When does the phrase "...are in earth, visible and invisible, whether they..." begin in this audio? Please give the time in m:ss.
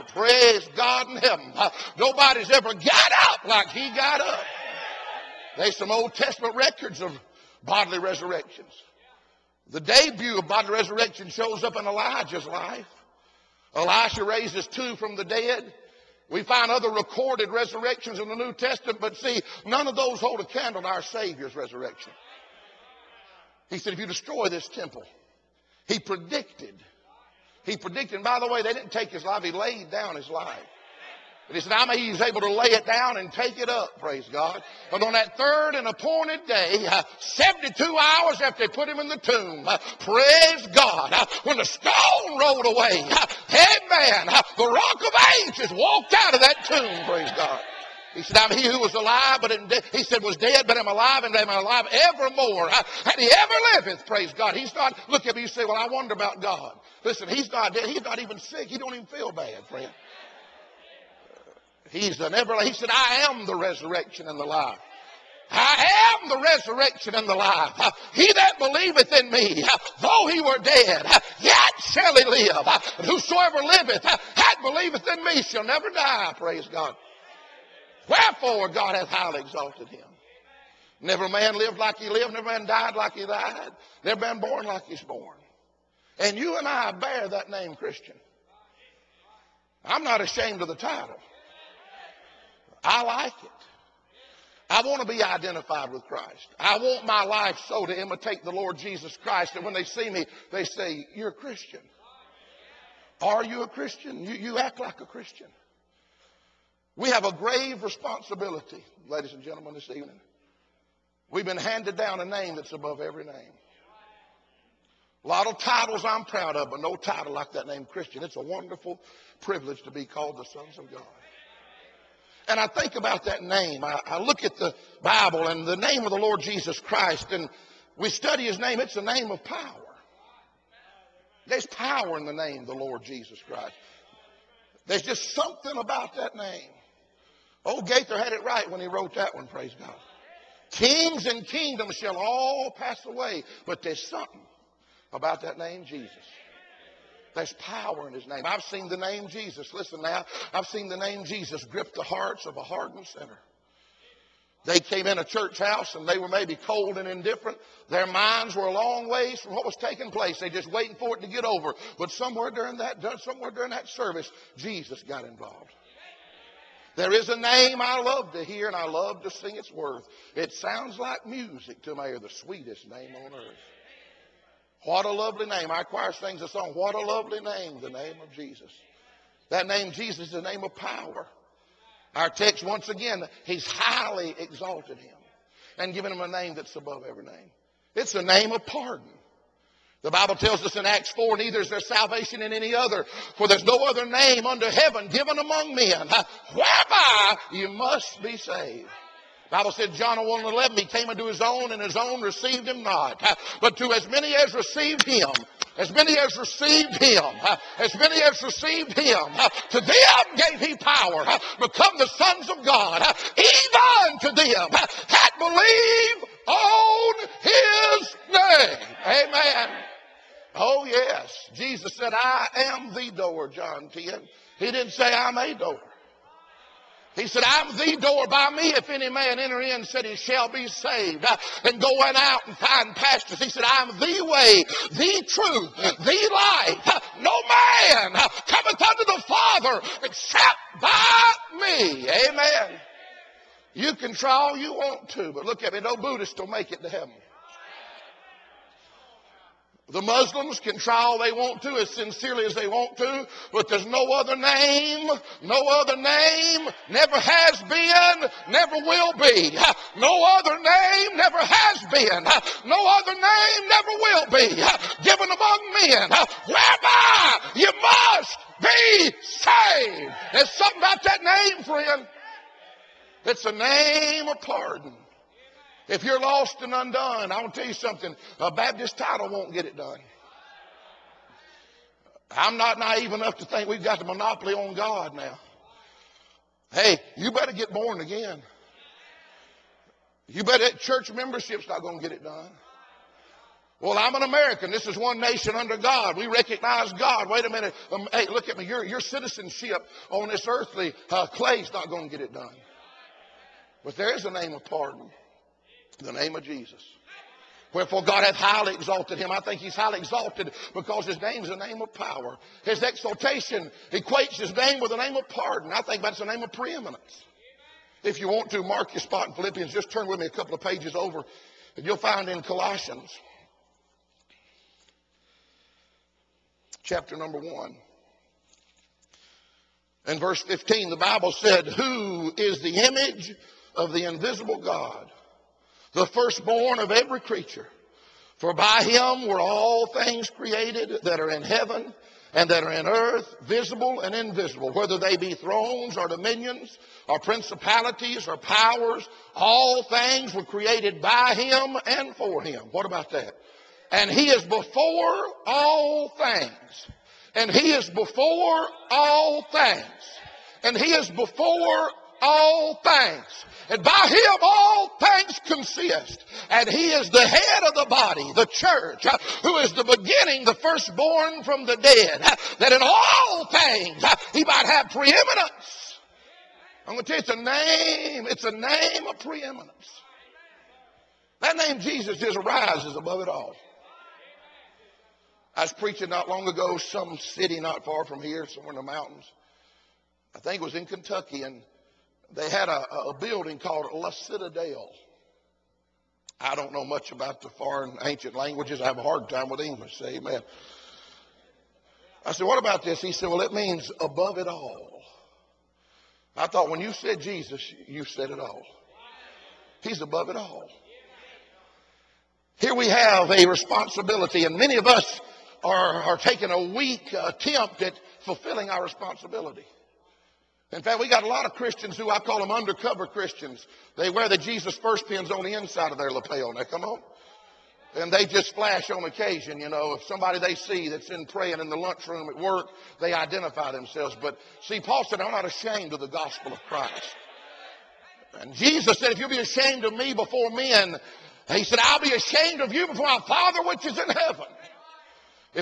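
5:42.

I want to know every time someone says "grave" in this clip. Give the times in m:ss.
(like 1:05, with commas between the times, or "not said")
1:47.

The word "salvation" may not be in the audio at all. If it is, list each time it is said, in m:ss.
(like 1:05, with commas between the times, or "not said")
3:11.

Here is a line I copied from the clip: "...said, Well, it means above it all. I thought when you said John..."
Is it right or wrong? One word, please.
wrong.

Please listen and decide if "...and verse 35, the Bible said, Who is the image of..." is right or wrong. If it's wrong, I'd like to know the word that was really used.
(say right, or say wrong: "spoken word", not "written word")
wrong: "15", not "35".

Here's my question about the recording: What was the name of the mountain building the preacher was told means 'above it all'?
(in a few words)
La Citadel.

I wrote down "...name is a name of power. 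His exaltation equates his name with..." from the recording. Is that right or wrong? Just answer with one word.
right.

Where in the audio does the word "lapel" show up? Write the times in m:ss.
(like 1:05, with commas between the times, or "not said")
7:06.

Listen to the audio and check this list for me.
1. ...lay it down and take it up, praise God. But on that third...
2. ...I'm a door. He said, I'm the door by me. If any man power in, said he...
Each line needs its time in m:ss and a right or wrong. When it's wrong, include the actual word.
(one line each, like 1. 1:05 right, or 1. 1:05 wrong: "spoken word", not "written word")
1. 0:32 right
2. 3:45 wrong: "enter", not "power".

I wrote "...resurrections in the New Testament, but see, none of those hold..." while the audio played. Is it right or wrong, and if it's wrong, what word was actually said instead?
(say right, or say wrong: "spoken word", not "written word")
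right.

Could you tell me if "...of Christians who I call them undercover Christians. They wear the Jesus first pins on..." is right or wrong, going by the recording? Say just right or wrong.
right.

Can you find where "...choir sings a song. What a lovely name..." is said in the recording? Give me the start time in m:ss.
2:55.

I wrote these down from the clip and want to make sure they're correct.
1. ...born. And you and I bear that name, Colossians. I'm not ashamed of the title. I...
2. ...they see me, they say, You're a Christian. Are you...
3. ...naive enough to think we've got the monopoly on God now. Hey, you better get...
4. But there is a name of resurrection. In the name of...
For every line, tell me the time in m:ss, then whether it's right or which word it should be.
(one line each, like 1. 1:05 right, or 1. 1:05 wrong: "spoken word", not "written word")
1. 1:25 wrong: "Christian", not "Colossians"
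2. 1:39 right
3. 4:42 right
4. 5:03 wrong: "pardon", not "resurrection".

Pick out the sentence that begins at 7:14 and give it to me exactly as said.
But see, Paul said, I'm not ashamed of the gospel of Christ.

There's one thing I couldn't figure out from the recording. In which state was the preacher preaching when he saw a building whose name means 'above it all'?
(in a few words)
Kentucky.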